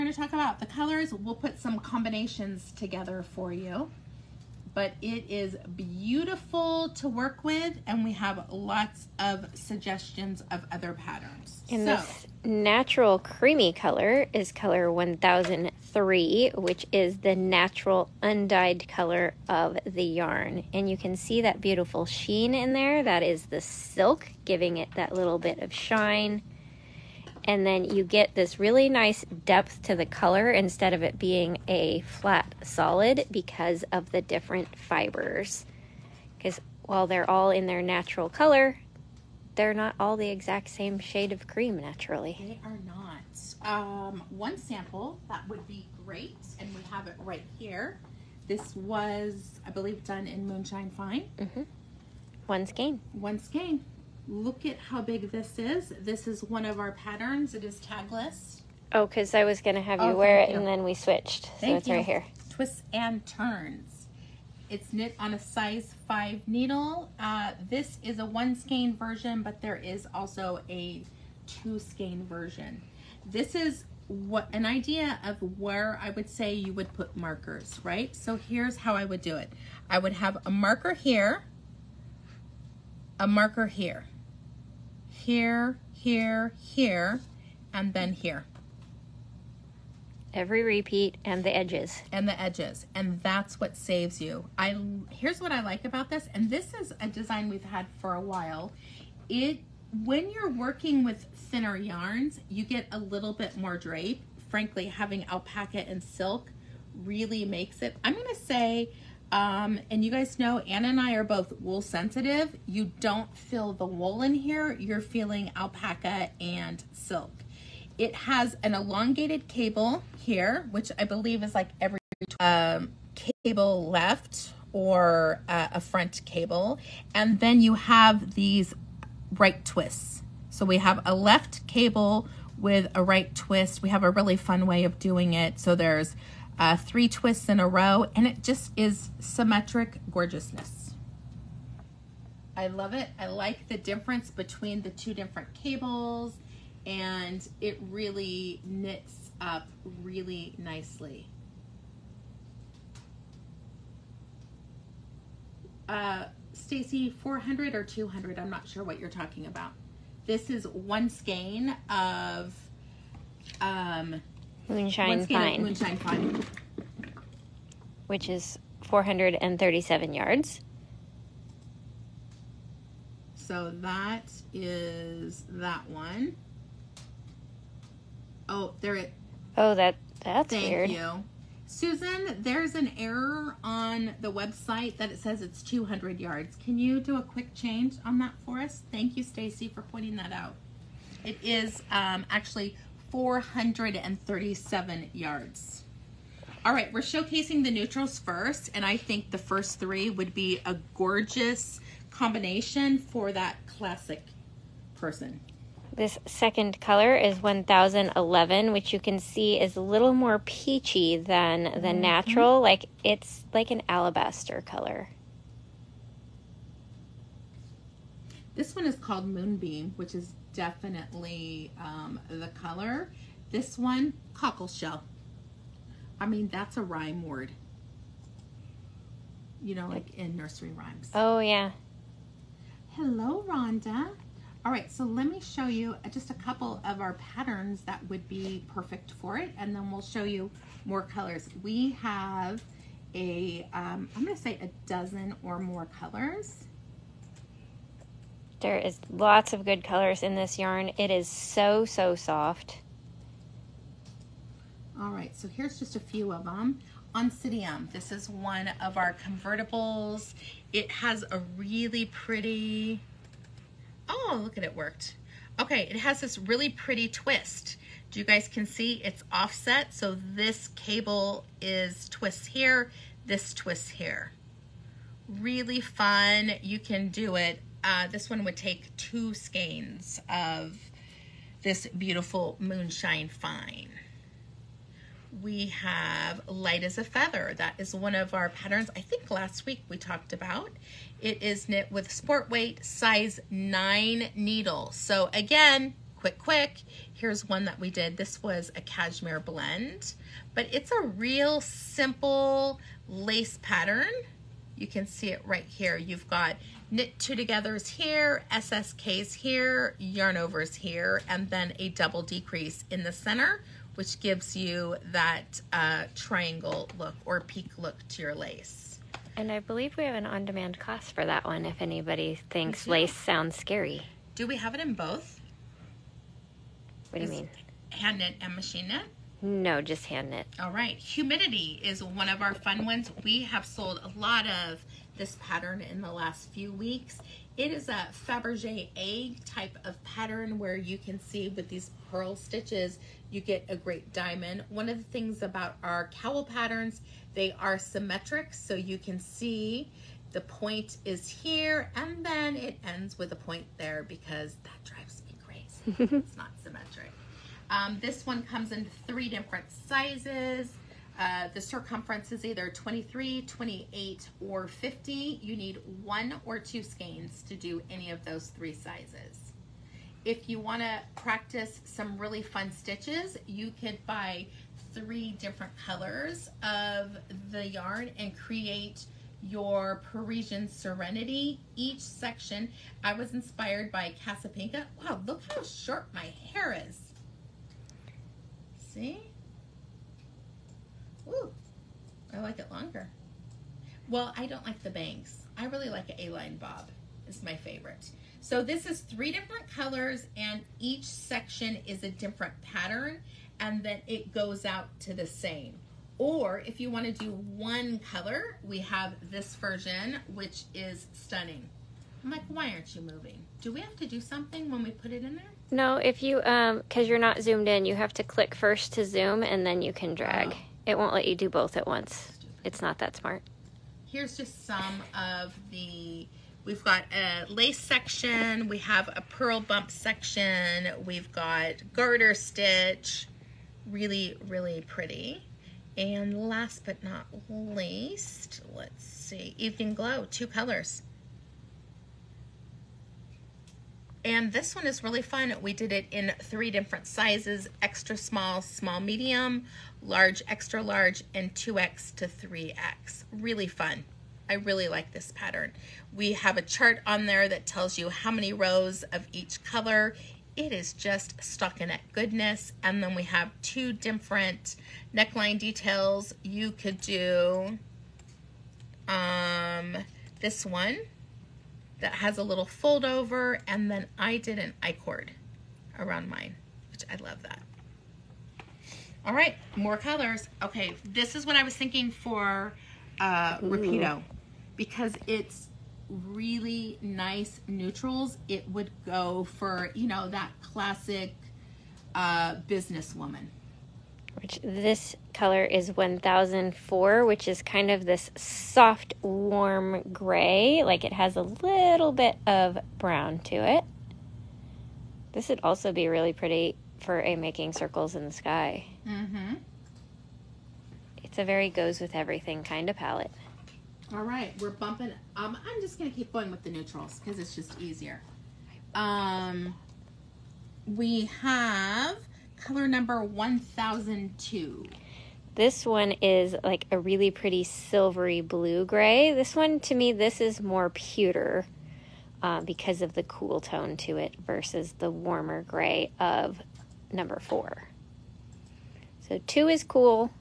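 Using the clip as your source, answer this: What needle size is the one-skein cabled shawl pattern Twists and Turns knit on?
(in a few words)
Size 5.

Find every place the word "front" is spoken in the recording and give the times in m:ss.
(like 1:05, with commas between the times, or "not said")
2:05.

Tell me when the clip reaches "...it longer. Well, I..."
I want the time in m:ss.
6:32.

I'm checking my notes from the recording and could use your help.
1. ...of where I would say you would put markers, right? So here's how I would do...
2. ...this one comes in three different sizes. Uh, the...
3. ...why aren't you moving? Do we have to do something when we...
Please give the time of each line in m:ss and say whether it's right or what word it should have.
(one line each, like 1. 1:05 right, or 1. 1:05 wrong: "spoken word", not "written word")
1. 1:15 right
2. 5:58 right
3. 6:52 right.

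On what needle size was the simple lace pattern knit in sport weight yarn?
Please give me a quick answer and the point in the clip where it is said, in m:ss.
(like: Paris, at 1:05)
Size 9, at 4:52.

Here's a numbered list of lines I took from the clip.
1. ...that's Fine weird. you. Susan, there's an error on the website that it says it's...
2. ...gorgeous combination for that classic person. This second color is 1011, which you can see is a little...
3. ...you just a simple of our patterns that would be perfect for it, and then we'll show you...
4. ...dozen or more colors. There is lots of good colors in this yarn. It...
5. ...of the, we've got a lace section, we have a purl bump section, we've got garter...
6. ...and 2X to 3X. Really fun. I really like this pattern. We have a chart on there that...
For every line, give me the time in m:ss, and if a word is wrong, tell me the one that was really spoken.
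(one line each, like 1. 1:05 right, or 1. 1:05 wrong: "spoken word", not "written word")
1. 3:00 wrong: "Thank", not "Fine"
2. 3:20 right
3. 3:55 wrong: "couple", not "simple"
4. 4:04 right
5. 7:05 right
6. 7:31 right.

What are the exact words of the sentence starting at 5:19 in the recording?
And I believe we have an on demand class for that one if anybody thinks lace sounds scary.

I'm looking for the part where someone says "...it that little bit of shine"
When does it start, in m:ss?
0:24.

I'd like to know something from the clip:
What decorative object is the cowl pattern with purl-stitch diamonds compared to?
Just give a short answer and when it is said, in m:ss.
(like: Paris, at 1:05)
Fabergé egg, at 5:38.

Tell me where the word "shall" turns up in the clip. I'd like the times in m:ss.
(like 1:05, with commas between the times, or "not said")
not said.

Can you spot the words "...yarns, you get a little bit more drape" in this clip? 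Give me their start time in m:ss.
1:41.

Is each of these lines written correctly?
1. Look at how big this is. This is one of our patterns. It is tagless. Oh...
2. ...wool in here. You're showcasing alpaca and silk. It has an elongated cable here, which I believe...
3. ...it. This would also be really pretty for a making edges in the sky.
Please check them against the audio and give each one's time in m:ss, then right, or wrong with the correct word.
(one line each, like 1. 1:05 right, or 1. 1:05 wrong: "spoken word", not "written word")
1. 0:54 right
2. 1:53 wrong: "feeling", not "showcasing"
3. 8:23 wrong: "circles", not "edges".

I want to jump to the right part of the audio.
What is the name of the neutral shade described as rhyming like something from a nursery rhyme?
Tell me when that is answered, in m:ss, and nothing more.
3:44.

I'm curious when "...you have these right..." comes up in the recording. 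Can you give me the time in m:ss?
2:07.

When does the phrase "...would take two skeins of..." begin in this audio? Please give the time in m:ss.
4:38.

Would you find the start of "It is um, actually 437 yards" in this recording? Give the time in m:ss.
3:11.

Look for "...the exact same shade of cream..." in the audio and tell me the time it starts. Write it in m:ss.
0:40.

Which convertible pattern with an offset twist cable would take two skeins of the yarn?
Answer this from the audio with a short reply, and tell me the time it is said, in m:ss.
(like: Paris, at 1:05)
Oncidium, at 4:17.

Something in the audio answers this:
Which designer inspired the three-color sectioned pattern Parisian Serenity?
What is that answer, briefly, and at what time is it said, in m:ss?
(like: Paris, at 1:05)
Casapinka, at 6:24.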